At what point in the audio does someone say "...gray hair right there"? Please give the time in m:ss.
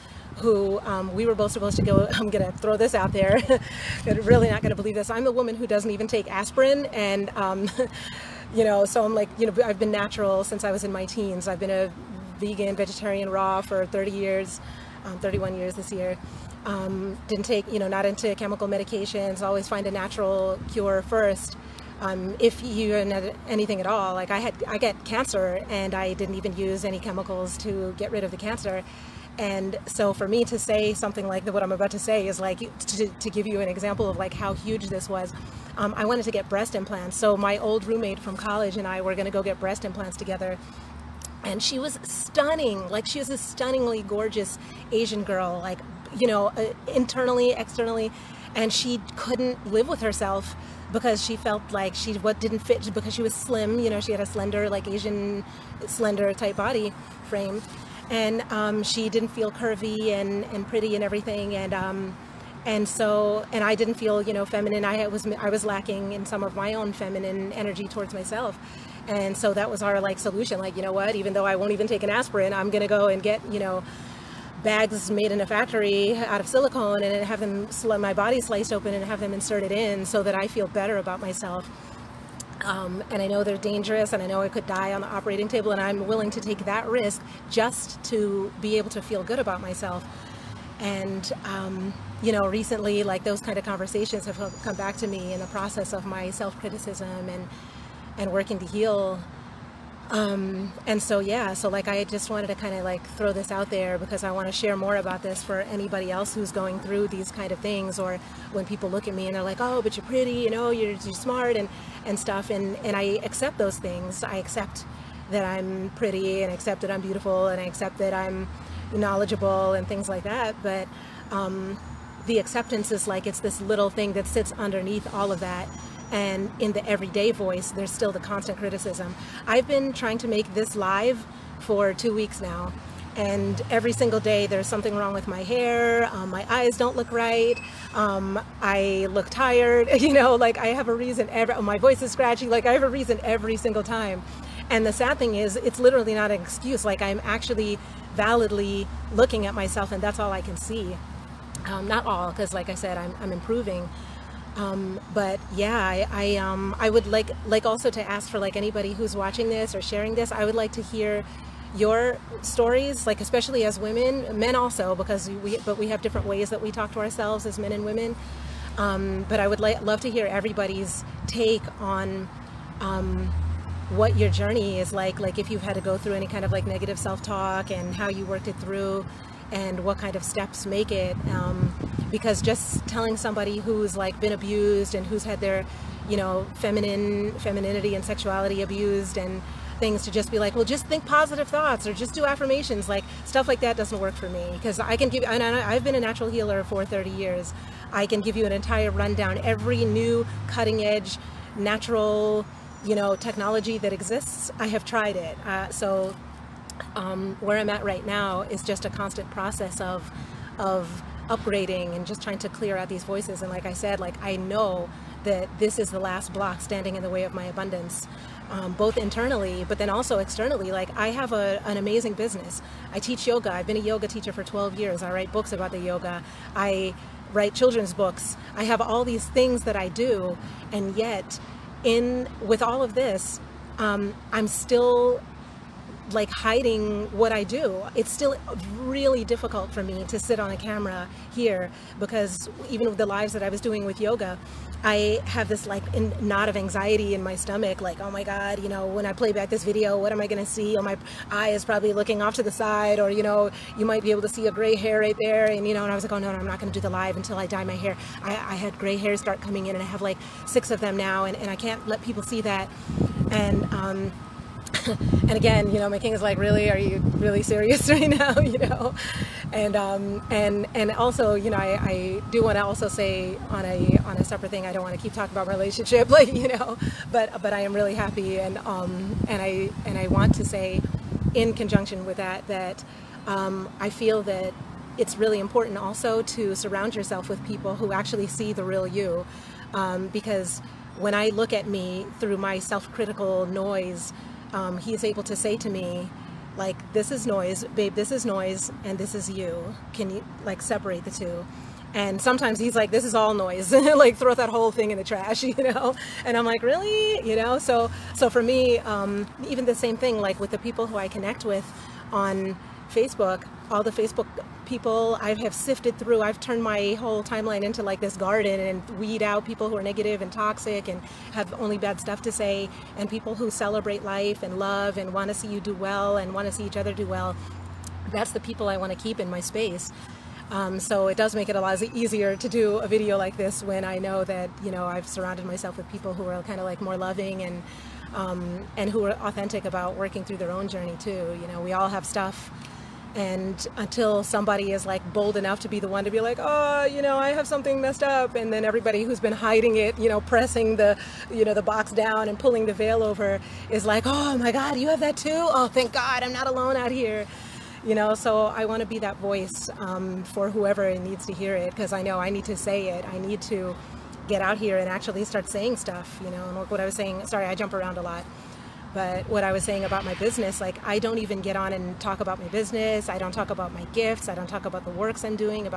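4:14.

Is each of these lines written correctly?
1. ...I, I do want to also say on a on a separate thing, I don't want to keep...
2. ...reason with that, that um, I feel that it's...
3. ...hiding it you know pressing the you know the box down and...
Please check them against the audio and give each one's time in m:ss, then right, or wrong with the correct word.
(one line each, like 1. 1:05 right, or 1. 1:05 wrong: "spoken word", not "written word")
1. 4:31 right
2. 4:41 wrong: "conjunction", not "reason"
3. 5:49 right.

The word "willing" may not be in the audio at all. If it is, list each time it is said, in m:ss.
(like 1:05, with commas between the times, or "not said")
1:26.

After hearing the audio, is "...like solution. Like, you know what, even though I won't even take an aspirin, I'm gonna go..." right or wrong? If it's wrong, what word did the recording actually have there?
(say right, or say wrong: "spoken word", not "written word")
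right.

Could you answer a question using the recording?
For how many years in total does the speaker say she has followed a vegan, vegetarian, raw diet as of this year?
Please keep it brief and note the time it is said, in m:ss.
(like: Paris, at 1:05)
31, at 0:15.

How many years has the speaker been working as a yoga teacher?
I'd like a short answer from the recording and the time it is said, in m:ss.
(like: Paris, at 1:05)
12, at 3:44.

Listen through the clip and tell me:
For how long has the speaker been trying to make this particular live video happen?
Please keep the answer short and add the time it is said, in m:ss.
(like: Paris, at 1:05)
Two weeks, at 2:11.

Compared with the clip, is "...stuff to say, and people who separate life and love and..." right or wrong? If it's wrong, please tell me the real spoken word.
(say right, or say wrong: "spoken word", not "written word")
wrong: "celebrate", not "separate".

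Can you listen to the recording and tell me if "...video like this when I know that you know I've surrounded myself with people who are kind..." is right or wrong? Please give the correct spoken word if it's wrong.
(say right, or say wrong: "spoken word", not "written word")
right.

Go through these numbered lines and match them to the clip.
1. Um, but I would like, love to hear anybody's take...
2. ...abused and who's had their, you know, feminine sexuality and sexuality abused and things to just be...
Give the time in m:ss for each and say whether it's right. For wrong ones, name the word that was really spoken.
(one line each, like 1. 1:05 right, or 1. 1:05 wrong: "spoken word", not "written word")
1. 2:48 wrong: "everybody", not "anybody"
2. 3:04 wrong: "femininity", not "sexuality".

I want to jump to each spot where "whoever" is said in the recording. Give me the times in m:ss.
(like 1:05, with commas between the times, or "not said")
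6:00.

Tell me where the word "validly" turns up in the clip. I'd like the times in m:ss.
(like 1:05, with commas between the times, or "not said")
2:28.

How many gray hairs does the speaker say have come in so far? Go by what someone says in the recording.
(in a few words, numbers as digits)
6.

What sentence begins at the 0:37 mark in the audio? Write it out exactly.
So my old roommate from college and I were going to go get breast implants together.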